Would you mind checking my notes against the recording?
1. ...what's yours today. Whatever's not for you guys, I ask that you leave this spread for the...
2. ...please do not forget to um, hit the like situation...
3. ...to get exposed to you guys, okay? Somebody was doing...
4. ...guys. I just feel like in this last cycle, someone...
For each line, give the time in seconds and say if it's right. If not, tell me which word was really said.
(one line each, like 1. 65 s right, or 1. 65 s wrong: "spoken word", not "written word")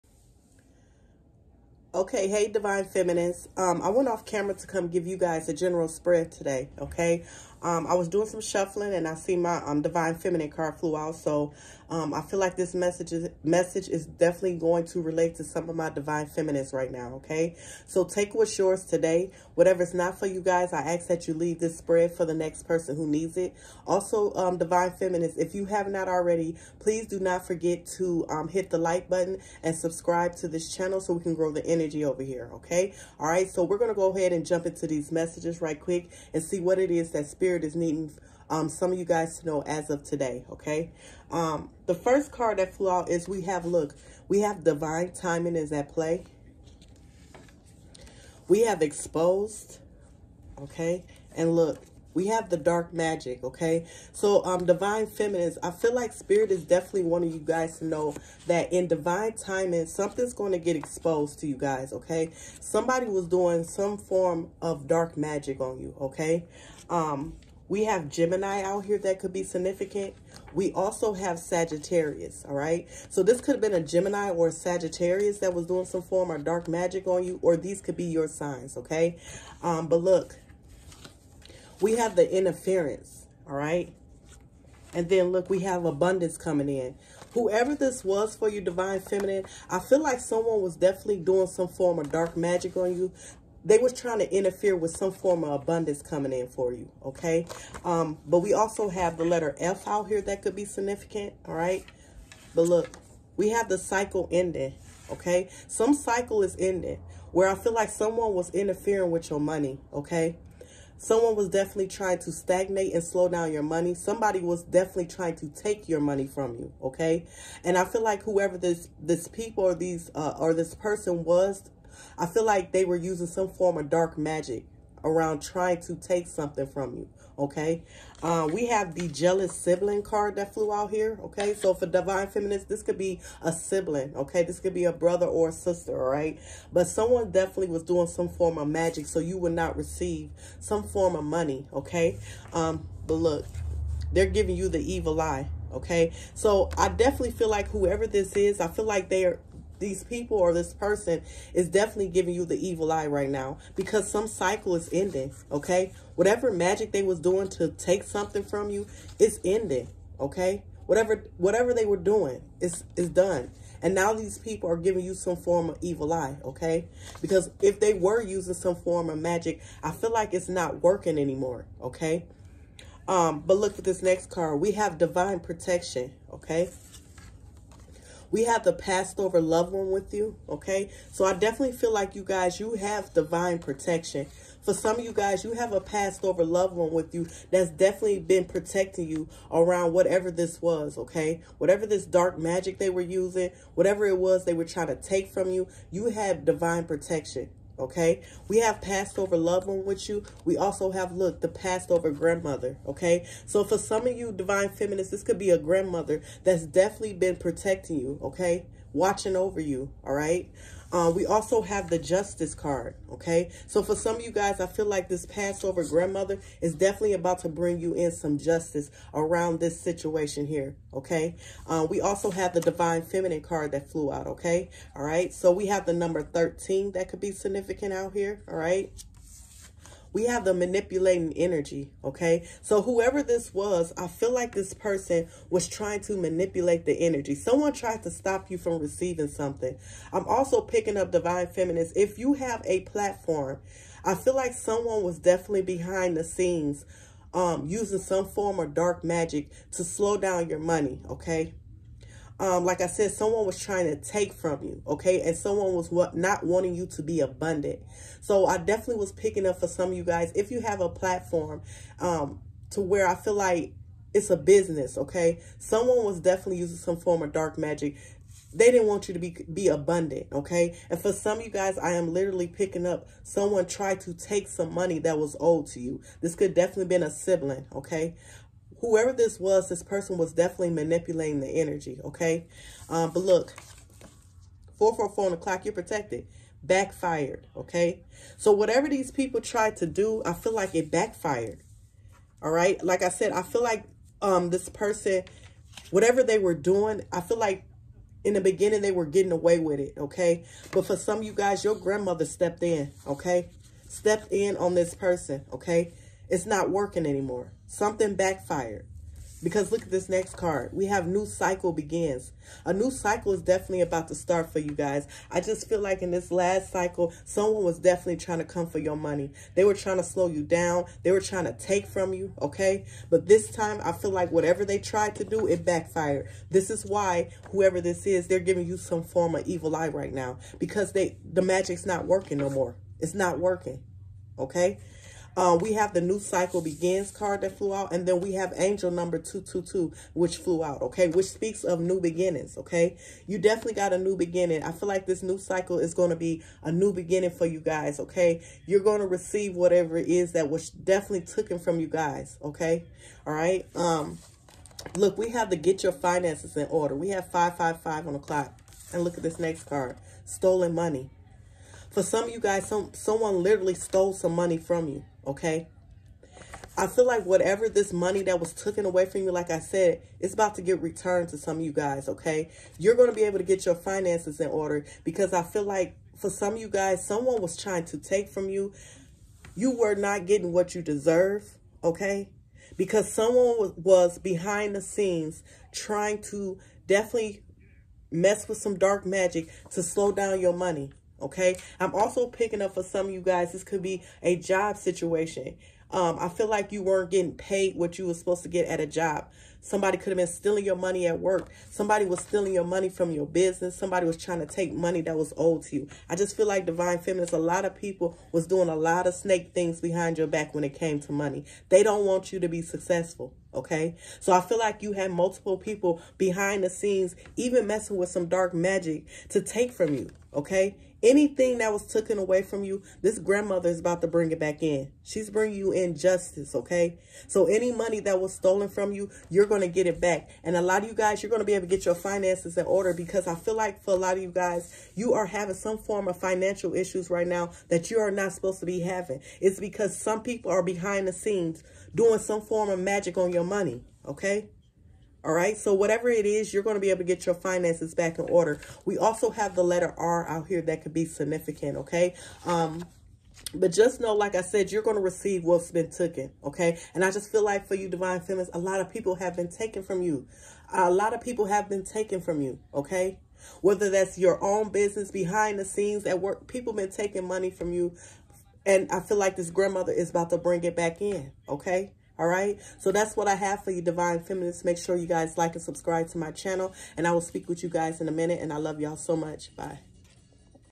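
1. 18 s right
2. 26 s wrong: "button", not "situation"
3. 60 s right
4. 314 s right.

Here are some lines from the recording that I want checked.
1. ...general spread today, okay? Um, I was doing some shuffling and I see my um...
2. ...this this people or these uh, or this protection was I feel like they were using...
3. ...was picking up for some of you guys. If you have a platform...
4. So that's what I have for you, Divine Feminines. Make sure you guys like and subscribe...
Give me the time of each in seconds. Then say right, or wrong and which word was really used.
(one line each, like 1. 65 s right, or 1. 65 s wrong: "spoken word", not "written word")
1. 5 s right
2. 118 s wrong: "person", not "protection"
3. 258 s right
4. 472 s right.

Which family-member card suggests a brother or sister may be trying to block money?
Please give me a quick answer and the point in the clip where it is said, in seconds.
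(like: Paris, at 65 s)
Jealous sibling, at 129 s.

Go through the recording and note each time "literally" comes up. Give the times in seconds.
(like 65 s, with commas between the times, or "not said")
272 s, 363 s.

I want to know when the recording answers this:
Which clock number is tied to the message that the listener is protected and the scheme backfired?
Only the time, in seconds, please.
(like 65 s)
284 s.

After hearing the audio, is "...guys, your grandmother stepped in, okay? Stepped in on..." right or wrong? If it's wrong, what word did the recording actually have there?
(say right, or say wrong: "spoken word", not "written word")
right.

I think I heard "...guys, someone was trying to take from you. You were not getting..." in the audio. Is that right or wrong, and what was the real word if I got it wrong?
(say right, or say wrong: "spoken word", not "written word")
right.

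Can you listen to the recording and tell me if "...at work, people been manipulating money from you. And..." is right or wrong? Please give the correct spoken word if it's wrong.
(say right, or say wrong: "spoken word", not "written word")
wrong: "taking", not "manipulating".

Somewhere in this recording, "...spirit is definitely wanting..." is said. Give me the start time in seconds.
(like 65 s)
56 s.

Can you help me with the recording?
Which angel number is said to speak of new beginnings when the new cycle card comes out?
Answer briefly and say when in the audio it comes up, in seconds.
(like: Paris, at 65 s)
222, at 339 s.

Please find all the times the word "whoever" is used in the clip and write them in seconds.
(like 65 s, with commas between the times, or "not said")
87 s, 118 s, 147 s, 232 s, 278 s, 327 s.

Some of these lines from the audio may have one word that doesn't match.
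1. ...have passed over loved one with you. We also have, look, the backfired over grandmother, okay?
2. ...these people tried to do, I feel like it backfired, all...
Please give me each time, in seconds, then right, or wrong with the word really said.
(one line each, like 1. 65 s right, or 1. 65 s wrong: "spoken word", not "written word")
1. 198 s wrong: "passed", not "backfired"
2. 288 s right.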